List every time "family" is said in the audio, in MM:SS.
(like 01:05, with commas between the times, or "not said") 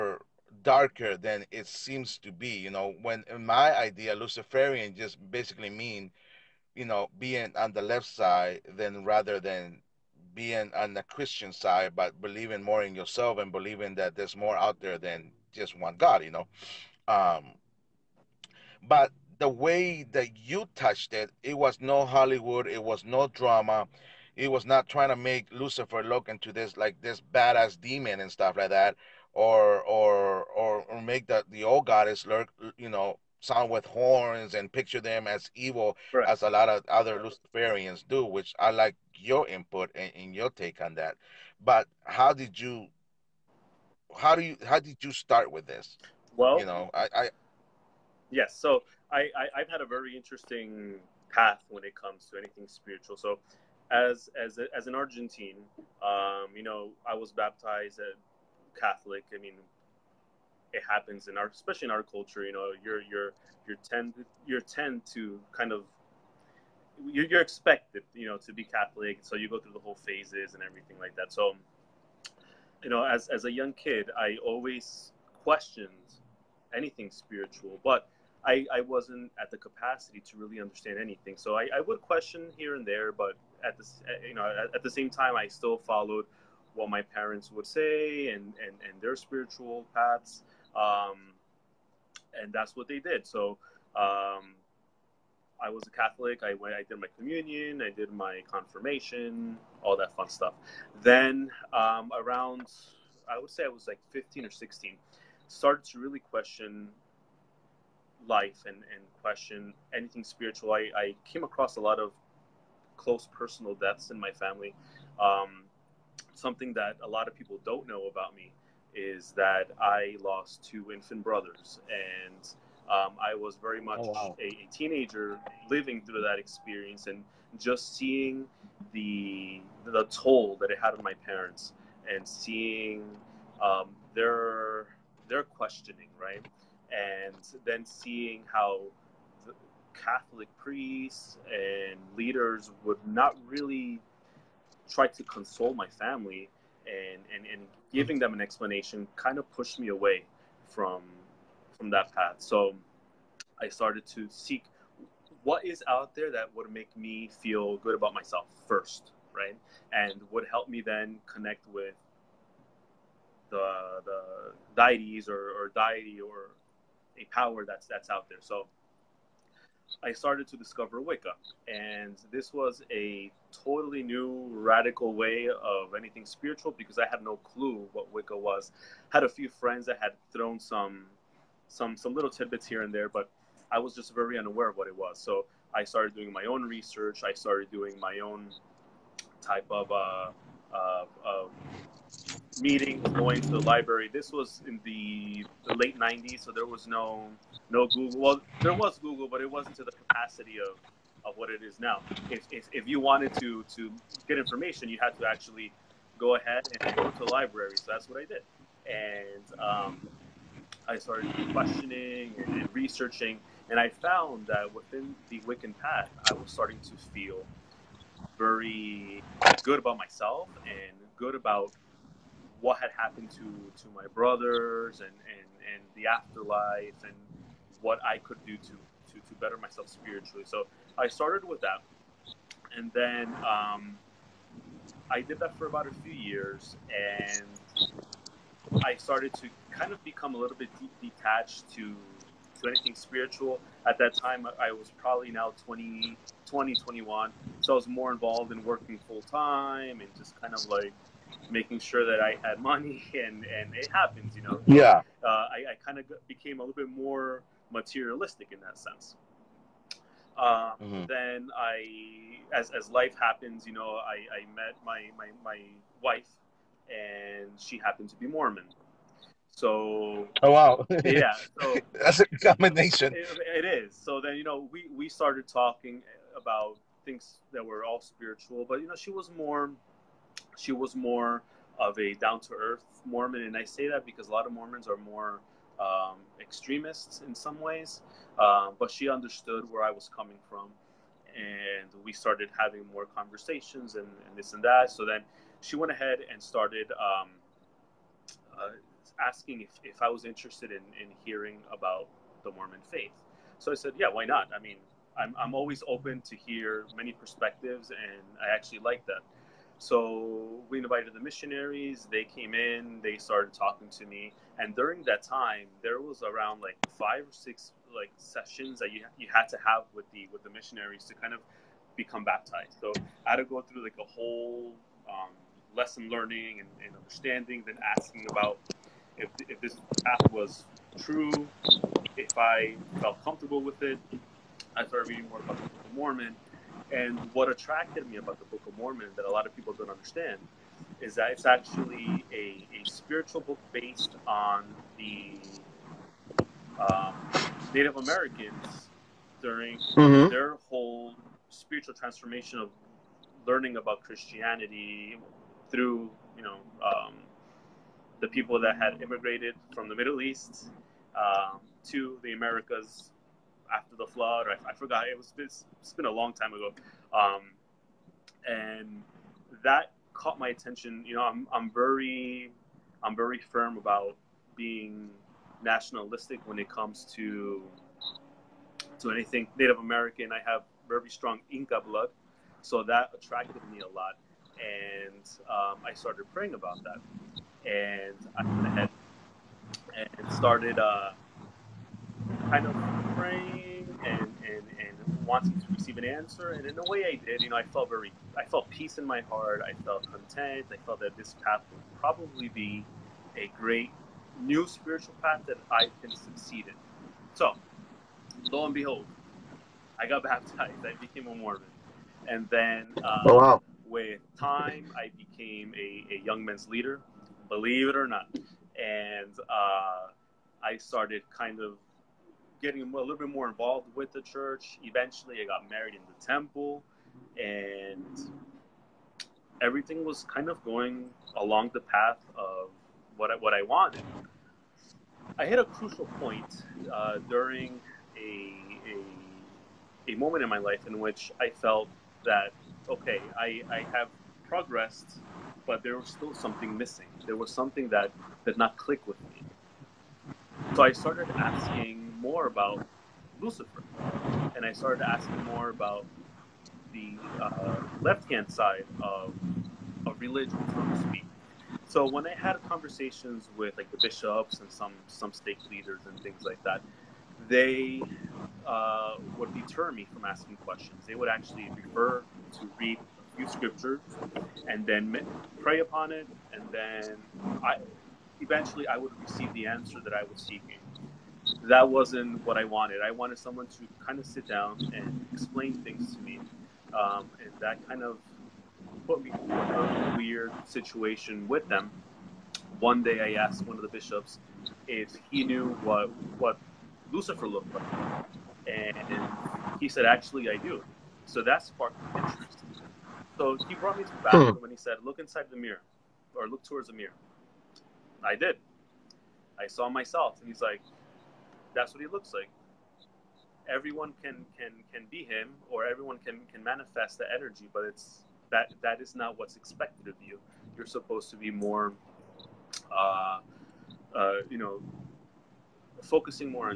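01:54, 02:25.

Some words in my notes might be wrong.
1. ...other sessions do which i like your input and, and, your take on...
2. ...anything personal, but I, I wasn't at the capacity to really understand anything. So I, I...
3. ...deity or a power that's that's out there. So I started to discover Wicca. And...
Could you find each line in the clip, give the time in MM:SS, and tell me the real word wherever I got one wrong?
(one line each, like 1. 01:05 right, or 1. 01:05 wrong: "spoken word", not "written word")
1. 00:36 wrong: "luciferians", not "sessions"
2. 01:16 wrong: "spiritual", not "personal"
3. 02:45 right.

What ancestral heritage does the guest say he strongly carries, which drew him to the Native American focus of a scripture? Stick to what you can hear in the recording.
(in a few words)
Inca.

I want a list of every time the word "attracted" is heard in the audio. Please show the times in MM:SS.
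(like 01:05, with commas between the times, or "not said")
05:37, 06:23.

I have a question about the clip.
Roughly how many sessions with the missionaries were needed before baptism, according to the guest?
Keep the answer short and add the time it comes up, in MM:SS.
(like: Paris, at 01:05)
5 or 6, at 05:16.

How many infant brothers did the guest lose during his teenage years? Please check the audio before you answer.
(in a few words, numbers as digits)
2.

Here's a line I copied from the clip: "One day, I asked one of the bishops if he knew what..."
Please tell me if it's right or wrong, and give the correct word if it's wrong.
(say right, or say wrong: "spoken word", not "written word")
right.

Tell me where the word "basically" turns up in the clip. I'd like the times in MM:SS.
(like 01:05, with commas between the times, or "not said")
00:05.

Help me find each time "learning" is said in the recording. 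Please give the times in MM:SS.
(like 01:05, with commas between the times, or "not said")
05:26, 05:53.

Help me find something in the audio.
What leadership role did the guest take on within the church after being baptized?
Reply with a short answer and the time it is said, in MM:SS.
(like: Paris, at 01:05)
Young men's leader, at 06:56.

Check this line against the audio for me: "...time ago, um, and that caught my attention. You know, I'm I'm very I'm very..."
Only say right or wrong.
right.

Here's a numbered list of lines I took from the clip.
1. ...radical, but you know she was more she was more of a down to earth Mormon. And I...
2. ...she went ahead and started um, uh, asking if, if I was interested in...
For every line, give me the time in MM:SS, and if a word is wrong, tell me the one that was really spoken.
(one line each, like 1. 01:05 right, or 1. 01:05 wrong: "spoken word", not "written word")
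1. 04:38 wrong: "spiritual", not "radical"
2. 04:55 right.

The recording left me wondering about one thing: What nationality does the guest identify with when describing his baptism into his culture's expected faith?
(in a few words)
Argentine.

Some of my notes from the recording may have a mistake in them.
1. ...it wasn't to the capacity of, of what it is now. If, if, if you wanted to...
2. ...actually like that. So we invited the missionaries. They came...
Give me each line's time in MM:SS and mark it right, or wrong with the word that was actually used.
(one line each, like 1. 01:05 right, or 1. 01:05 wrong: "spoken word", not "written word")
1. 03:19 right
2. 05:08 right.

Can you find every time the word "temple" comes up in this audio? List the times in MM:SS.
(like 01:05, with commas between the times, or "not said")
07:06.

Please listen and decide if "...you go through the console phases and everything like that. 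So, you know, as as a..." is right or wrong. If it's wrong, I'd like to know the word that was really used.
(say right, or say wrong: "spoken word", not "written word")
wrong: "whole", not "console".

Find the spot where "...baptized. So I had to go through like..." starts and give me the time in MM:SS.
05:22.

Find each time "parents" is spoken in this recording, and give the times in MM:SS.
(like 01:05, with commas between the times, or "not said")
01:27, 02:11.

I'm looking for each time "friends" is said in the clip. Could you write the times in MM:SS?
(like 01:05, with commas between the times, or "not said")
02:59.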